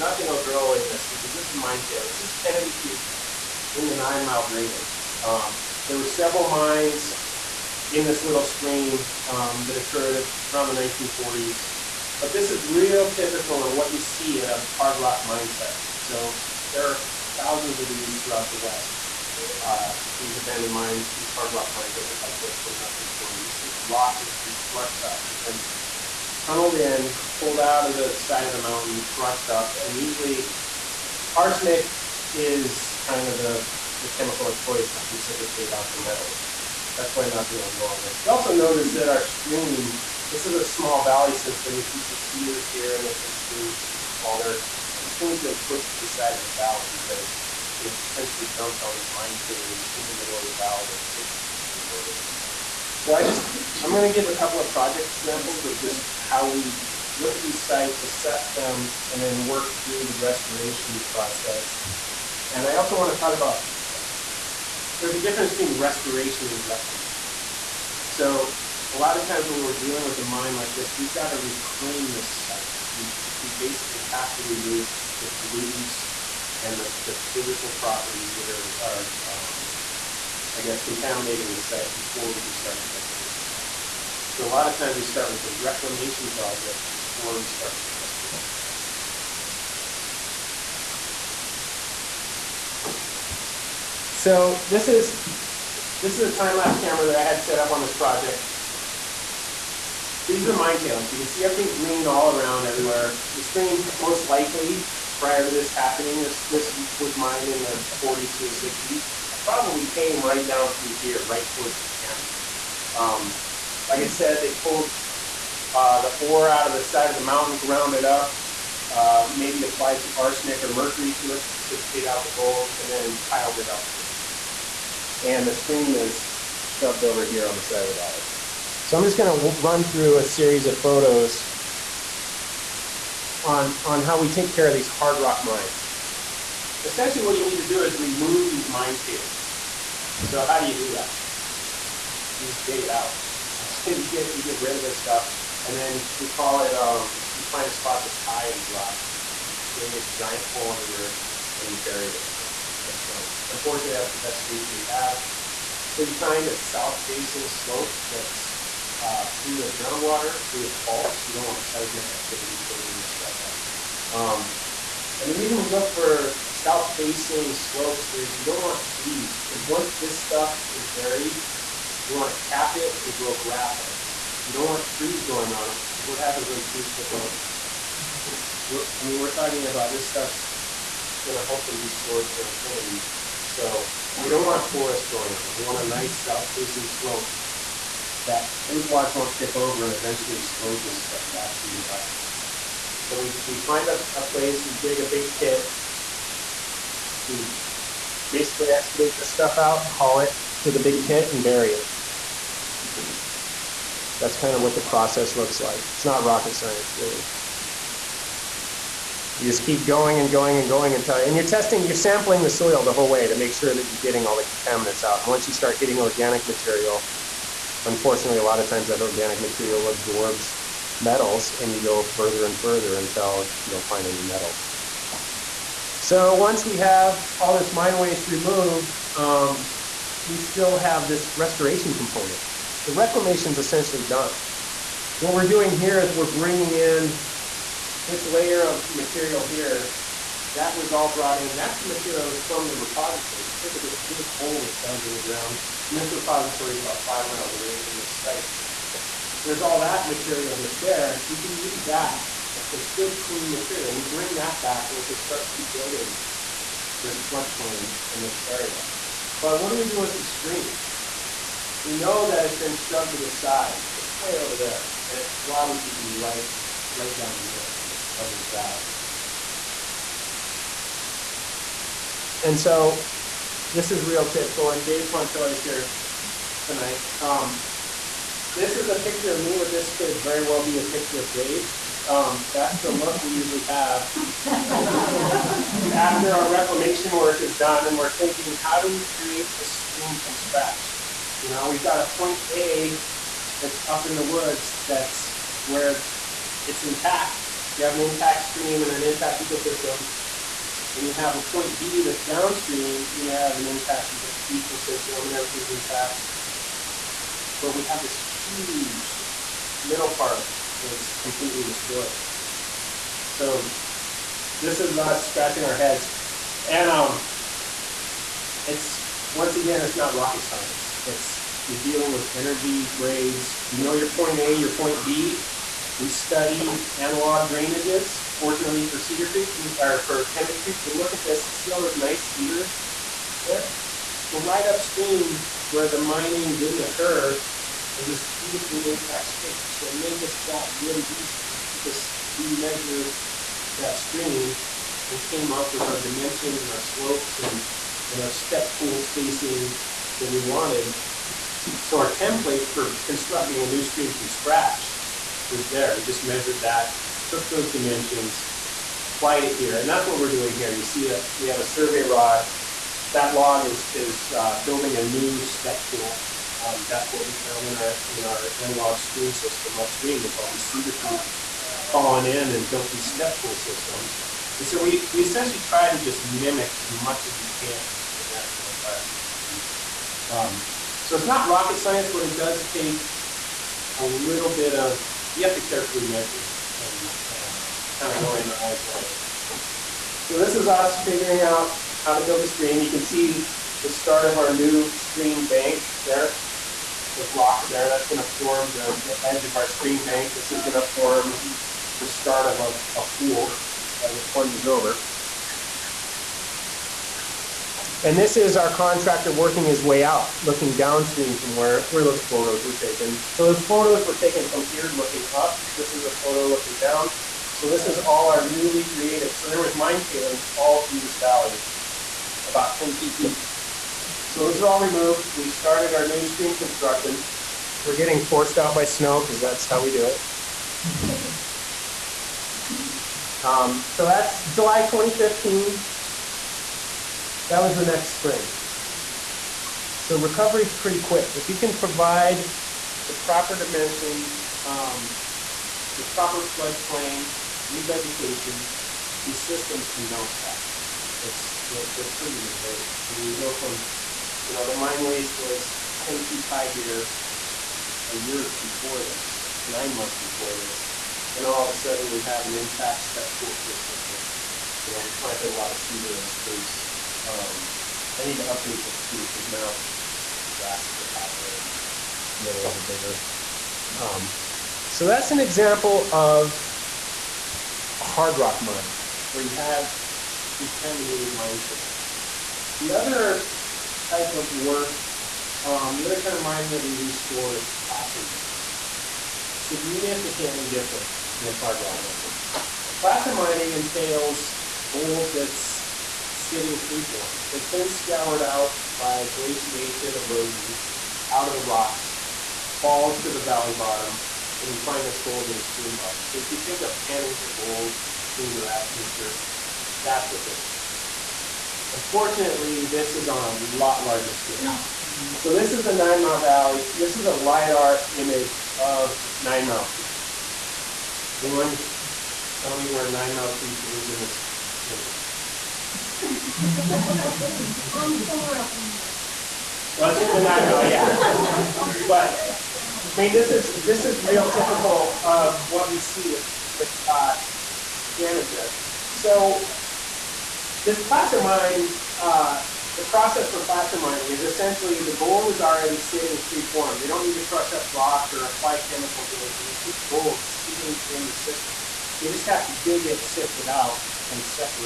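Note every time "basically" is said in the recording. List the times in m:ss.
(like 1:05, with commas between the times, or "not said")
1:13, 3:18.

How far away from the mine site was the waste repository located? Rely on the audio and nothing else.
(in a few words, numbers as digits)
5 miles.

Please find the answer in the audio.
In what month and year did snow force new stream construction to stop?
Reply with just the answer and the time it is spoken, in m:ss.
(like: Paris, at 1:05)
July 2015, at 7:14.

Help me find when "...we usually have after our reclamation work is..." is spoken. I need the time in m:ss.
4:43.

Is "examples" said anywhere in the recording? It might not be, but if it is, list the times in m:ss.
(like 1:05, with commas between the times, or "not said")
0:55, 7:55.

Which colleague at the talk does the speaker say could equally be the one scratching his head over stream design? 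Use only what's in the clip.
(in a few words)
Dave Poncho.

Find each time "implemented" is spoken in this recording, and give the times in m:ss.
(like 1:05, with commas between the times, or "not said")
not said.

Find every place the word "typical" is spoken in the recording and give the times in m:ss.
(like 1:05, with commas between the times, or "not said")
0:13, 4:34, 8:54.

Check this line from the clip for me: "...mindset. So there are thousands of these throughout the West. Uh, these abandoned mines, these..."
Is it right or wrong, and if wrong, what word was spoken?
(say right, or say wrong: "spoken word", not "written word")
right.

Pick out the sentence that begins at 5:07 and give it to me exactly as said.
But we have this huge middle part that's completely destroyed.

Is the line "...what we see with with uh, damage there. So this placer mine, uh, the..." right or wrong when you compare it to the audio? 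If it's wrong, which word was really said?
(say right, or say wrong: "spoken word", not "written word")
right.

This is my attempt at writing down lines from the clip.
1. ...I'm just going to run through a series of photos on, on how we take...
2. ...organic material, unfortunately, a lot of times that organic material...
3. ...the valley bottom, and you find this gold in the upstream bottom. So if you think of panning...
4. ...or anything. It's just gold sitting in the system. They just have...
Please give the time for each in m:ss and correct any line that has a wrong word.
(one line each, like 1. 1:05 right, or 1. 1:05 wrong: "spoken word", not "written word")
1. 2:08 right
2. 3:35 right
3. 8:23 wrong: "stream", not "upstream"
4. 9:09 right.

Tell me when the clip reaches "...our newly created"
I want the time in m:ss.
6:58.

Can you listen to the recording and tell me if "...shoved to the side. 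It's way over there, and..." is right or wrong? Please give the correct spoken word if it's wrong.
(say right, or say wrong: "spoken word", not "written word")
right.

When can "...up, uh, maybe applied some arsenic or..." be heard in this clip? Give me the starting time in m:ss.
1:58.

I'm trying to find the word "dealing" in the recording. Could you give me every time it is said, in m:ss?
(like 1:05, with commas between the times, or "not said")
1:09, 5:21.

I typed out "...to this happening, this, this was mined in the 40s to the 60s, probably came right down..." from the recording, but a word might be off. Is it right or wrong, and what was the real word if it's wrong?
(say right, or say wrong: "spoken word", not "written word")
right.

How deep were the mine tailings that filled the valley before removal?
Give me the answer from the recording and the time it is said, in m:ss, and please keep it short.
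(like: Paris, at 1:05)
10 feet, at 7:02.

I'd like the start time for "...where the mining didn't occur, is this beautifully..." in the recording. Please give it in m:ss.
5:35.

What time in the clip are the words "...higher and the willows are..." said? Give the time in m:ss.
7:51.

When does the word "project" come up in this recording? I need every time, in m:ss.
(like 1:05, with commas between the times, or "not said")
0:54, 1:26, 1:37.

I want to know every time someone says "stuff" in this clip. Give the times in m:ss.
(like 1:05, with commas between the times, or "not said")
2:24, 2:32, 2:43, 2:50, 3:00, 3:11, 3:19.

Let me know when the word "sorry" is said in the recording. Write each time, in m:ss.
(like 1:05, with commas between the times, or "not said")
not said.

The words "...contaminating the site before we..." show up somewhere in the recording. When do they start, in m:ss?
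1:20.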